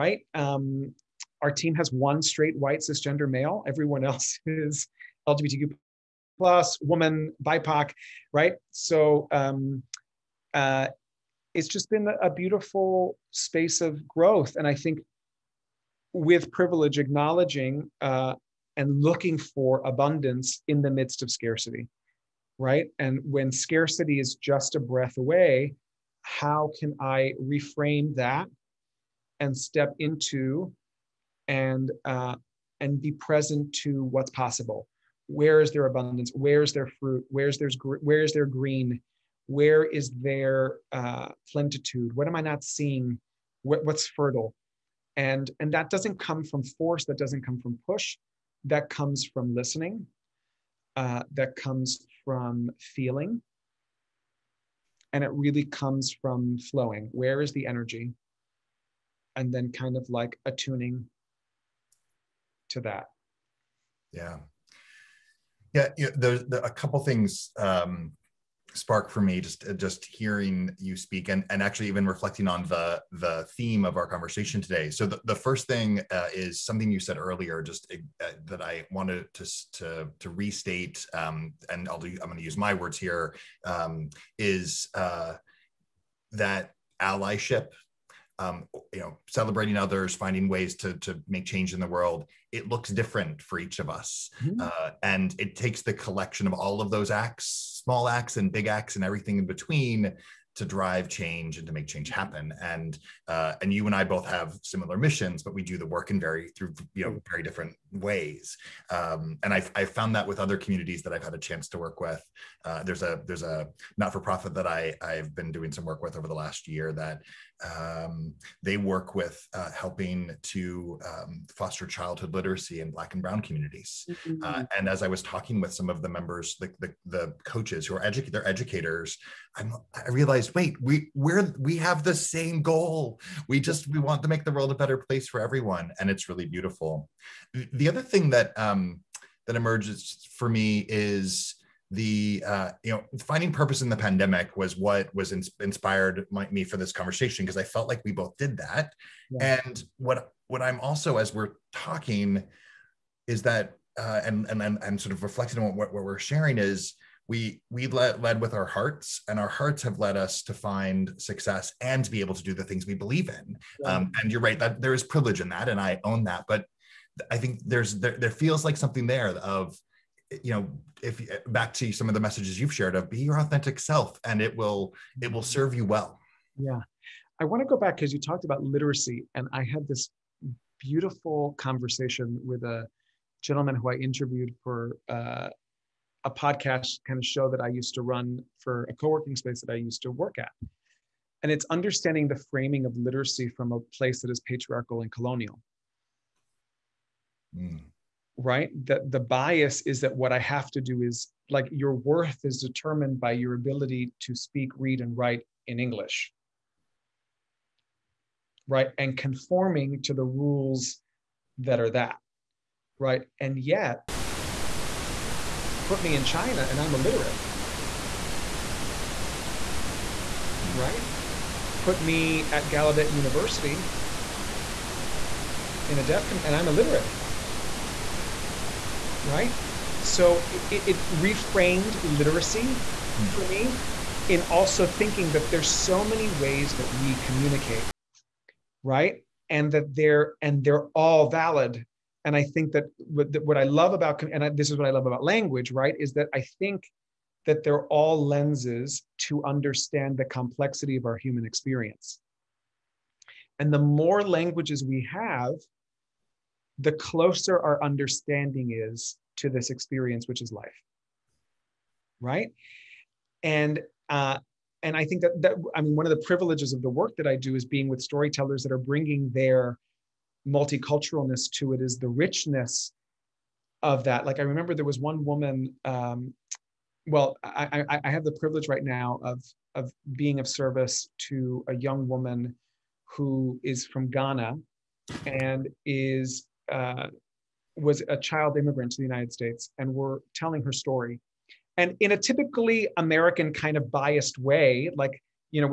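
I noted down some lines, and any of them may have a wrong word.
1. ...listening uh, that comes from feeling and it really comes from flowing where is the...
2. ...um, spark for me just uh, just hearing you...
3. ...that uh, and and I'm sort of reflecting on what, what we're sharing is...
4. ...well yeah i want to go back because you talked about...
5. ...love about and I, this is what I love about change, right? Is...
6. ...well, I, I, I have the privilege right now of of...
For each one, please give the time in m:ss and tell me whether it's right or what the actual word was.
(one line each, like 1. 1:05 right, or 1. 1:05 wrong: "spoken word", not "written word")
1. 0:49 right
2. 1:07 right
3. 2:33 right
4. 2:55 right
5. 4:03 wrong: "language", not "change"
6. 4:37 right.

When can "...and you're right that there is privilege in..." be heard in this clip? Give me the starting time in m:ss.
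2:44.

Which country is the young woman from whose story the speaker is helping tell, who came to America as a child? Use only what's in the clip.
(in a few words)
Ghana.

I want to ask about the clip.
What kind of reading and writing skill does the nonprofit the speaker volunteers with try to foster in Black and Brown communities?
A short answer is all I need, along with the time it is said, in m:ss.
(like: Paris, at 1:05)
childhood literacy, at 2:01.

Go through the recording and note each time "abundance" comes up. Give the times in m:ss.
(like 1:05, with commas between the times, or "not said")
0:19, 0:35.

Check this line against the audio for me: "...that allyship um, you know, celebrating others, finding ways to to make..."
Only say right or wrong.
right.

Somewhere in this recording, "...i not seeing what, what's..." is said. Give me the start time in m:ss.
0:42.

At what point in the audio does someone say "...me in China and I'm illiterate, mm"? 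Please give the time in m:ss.
3:36.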